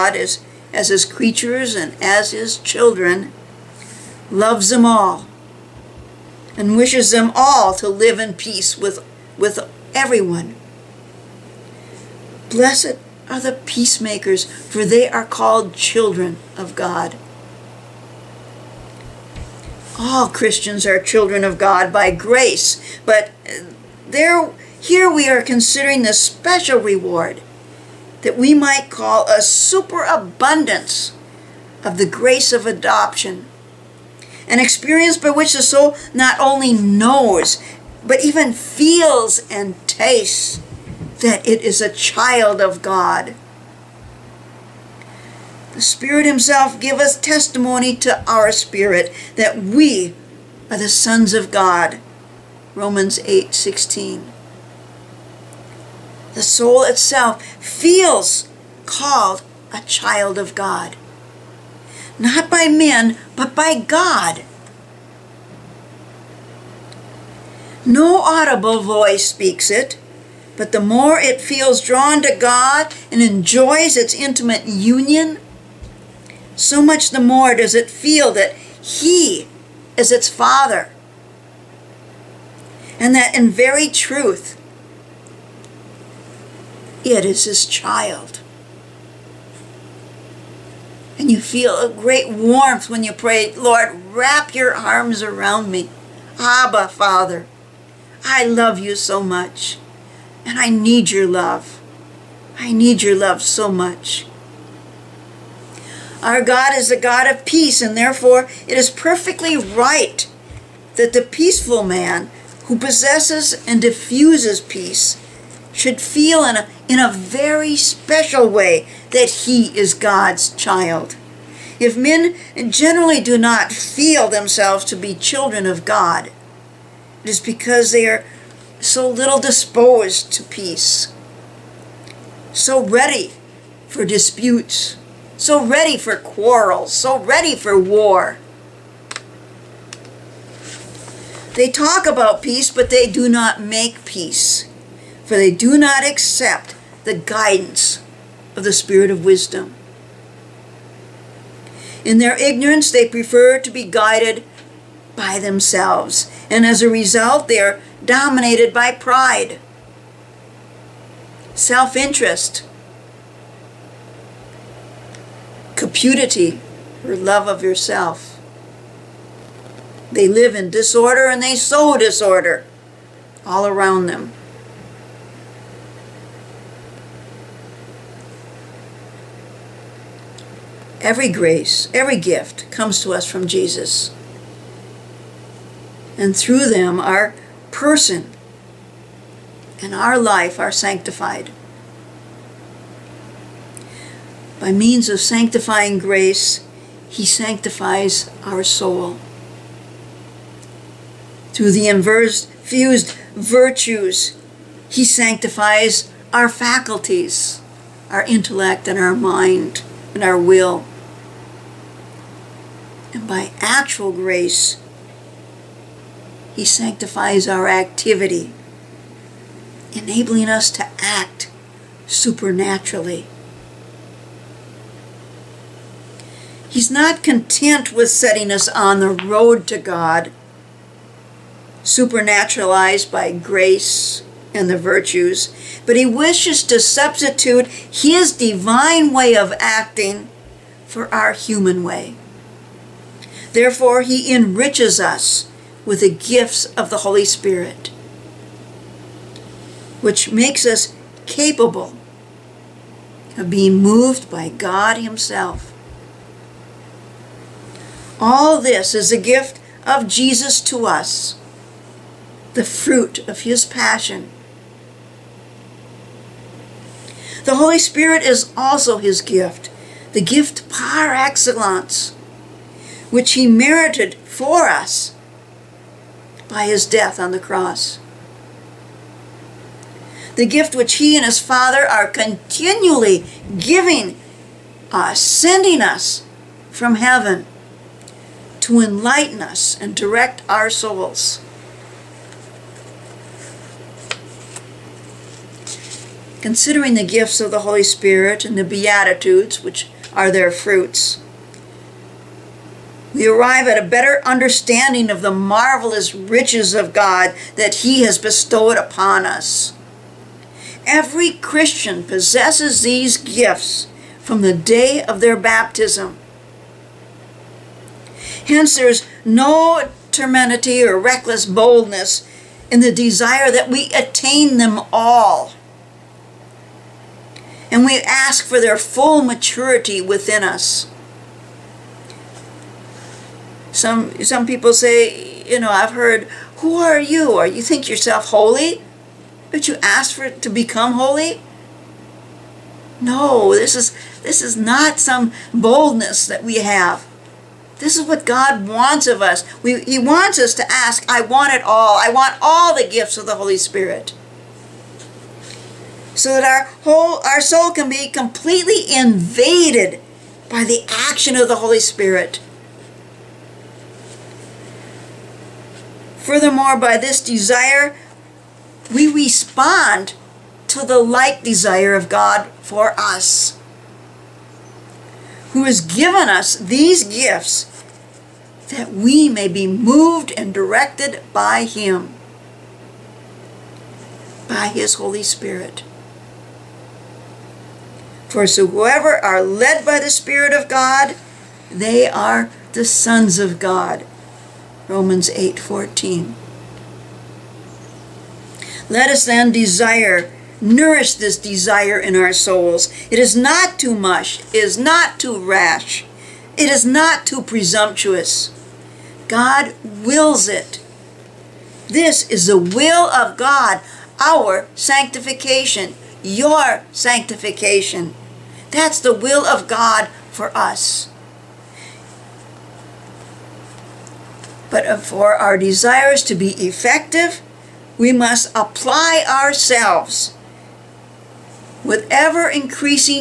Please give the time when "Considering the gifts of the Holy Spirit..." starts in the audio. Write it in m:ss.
4:56.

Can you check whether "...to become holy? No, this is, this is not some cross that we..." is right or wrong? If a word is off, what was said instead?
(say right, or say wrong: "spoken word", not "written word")
wrong: "boldness", not "cross".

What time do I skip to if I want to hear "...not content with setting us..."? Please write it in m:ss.
3:46.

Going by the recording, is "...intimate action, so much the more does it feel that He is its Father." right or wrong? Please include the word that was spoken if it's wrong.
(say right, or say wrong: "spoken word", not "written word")
wrong: "union", not "action".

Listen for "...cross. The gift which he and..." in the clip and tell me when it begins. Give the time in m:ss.
4:37.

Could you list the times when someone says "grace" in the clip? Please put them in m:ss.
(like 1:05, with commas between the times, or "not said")
0:22, 0:32, 3:01, 3:15, 3:34, 3:53.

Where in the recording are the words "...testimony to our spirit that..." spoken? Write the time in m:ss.
0:47.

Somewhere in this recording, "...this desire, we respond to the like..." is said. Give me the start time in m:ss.
6:06.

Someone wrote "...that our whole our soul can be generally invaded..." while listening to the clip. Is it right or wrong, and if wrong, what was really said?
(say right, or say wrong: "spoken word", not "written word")
wrong: "completely", not "generally".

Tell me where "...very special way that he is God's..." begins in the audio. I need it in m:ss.
1:57.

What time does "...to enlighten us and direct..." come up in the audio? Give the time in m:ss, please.
4:48.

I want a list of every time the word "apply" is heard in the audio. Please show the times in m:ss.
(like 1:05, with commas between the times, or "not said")
7:08.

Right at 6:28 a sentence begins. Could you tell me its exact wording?
For so whoever are led by the Spirit of God, they are the sons of God.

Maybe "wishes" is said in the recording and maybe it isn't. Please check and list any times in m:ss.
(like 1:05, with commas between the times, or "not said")
0:06, 3:56.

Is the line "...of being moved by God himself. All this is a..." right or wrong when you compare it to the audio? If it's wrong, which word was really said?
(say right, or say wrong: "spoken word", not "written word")
right.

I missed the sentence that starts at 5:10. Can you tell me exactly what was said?
Every Christian possesses these gifts from the day of their baptism.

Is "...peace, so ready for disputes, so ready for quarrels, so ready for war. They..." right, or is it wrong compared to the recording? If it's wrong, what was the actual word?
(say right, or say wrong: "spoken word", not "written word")
right.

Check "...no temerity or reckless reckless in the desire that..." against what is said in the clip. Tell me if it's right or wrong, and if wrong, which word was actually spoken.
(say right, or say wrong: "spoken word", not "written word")
wrong: "boldness", not "reckless".